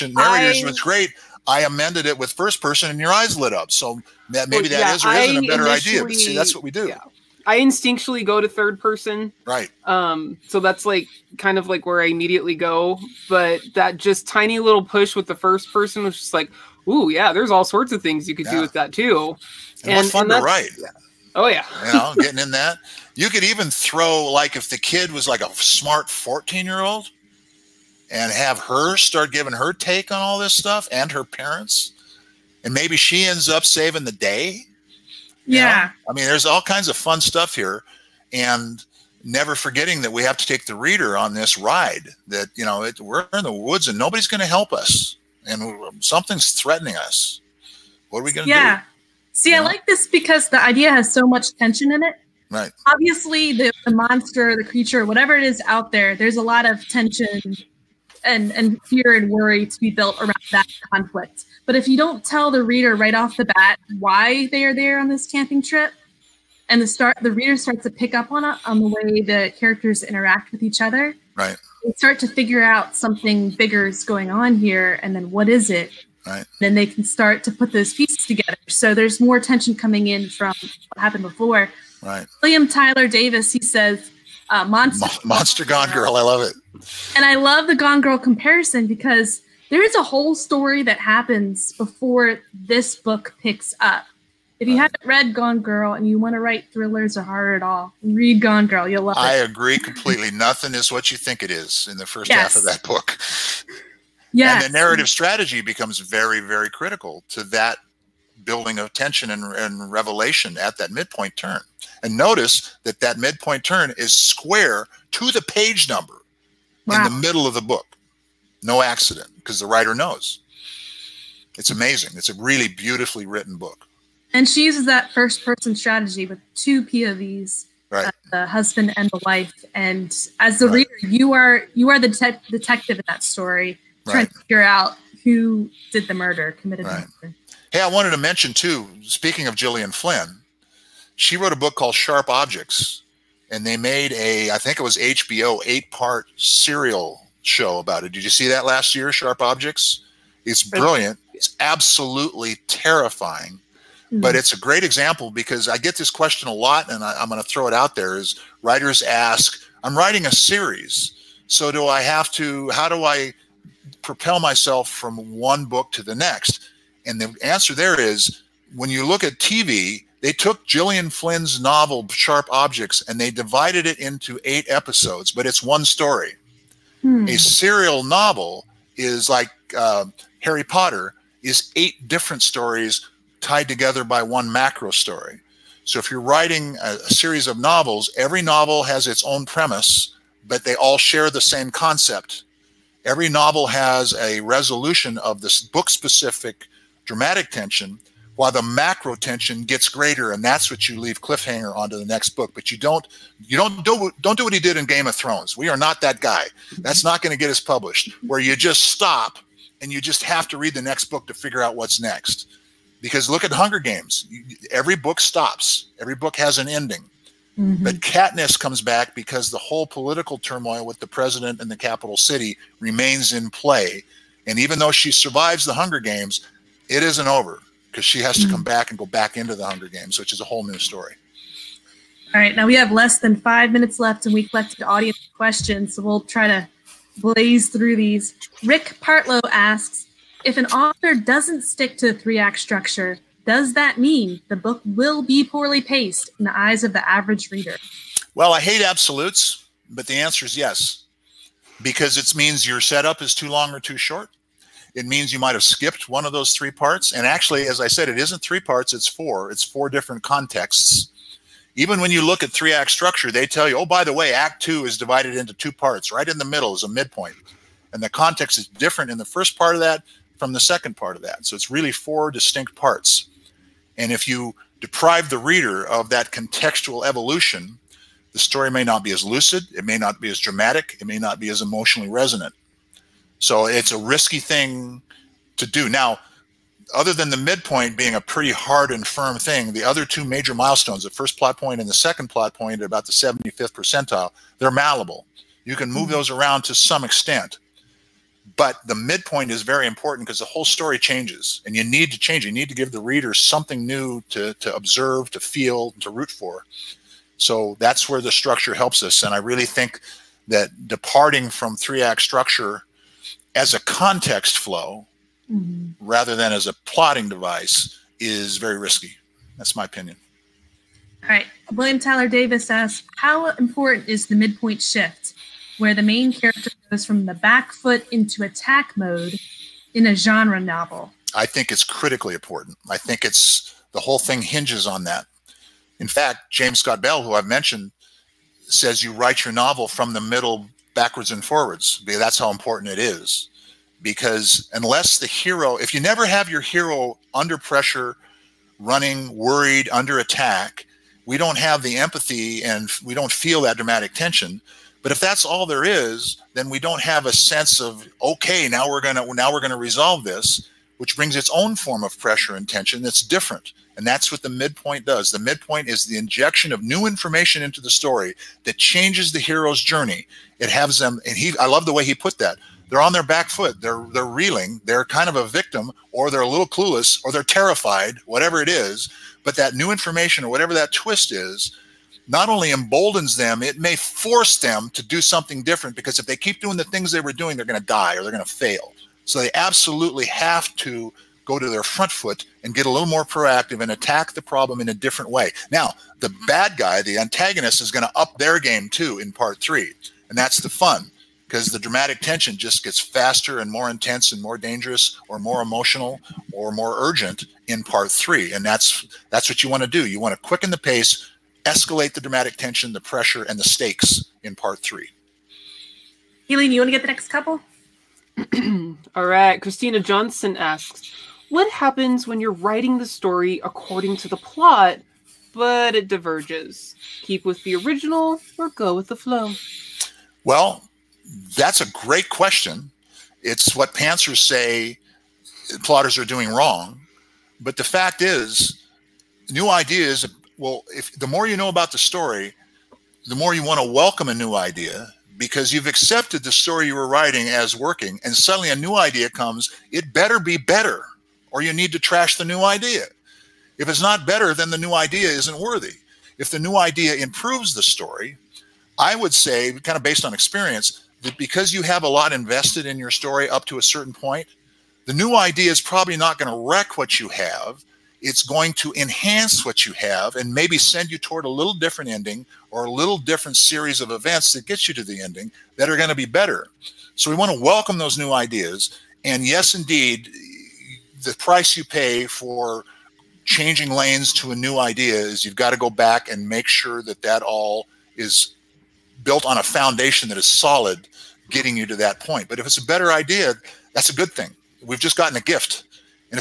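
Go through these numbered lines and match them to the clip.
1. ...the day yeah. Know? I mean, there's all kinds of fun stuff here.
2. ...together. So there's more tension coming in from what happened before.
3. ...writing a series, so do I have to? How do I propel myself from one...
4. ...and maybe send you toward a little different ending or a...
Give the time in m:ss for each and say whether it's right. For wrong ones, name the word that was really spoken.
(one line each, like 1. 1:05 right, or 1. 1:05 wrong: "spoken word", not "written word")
1. 0:34 right
2. 1:18 right
3. 2:39 right
4. 7:50 right.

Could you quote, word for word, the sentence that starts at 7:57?
So we want to welcome those new ideas.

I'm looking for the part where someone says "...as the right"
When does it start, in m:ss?
2:10.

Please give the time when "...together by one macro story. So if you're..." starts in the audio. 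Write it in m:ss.
3:03.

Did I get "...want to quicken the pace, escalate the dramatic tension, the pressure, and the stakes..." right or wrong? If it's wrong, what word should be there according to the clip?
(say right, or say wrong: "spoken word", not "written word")
right.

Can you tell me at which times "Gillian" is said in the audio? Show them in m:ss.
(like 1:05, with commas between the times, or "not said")
2:19, 2:50.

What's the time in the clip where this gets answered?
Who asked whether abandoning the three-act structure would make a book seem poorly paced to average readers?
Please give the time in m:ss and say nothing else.
3:58.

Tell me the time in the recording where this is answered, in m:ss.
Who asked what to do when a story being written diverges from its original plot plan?
6:59.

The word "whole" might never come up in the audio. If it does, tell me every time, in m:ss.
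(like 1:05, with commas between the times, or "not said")
1:30, 3:39, 3:50, 5:00, 5:33.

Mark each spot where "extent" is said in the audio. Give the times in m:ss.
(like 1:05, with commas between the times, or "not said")
4:57.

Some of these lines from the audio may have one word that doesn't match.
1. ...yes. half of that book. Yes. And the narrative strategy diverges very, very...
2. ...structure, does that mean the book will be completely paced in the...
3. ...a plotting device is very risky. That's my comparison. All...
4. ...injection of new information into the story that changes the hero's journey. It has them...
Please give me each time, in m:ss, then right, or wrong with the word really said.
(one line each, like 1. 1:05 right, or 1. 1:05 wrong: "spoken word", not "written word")
1. 1:42 wrong: "becomes", not "diverges"
2. 4:02 wrong: "poorly", not "completely"
3. 5:16 wrong: "opinion", not "comparison"
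4. 6:06 right.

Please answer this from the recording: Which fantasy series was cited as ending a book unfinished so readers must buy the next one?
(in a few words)
Game of Thrones.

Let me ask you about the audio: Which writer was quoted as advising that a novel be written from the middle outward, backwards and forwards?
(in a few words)
James Scott Bell.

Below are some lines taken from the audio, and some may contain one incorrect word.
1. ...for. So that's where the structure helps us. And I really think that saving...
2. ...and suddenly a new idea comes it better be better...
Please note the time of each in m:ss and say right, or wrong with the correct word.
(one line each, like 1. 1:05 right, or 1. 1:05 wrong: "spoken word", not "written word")
1. 5:06 wrong: "departing", not "saving"
2. 7:28 right.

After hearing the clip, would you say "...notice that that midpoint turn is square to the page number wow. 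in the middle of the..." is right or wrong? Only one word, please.
right.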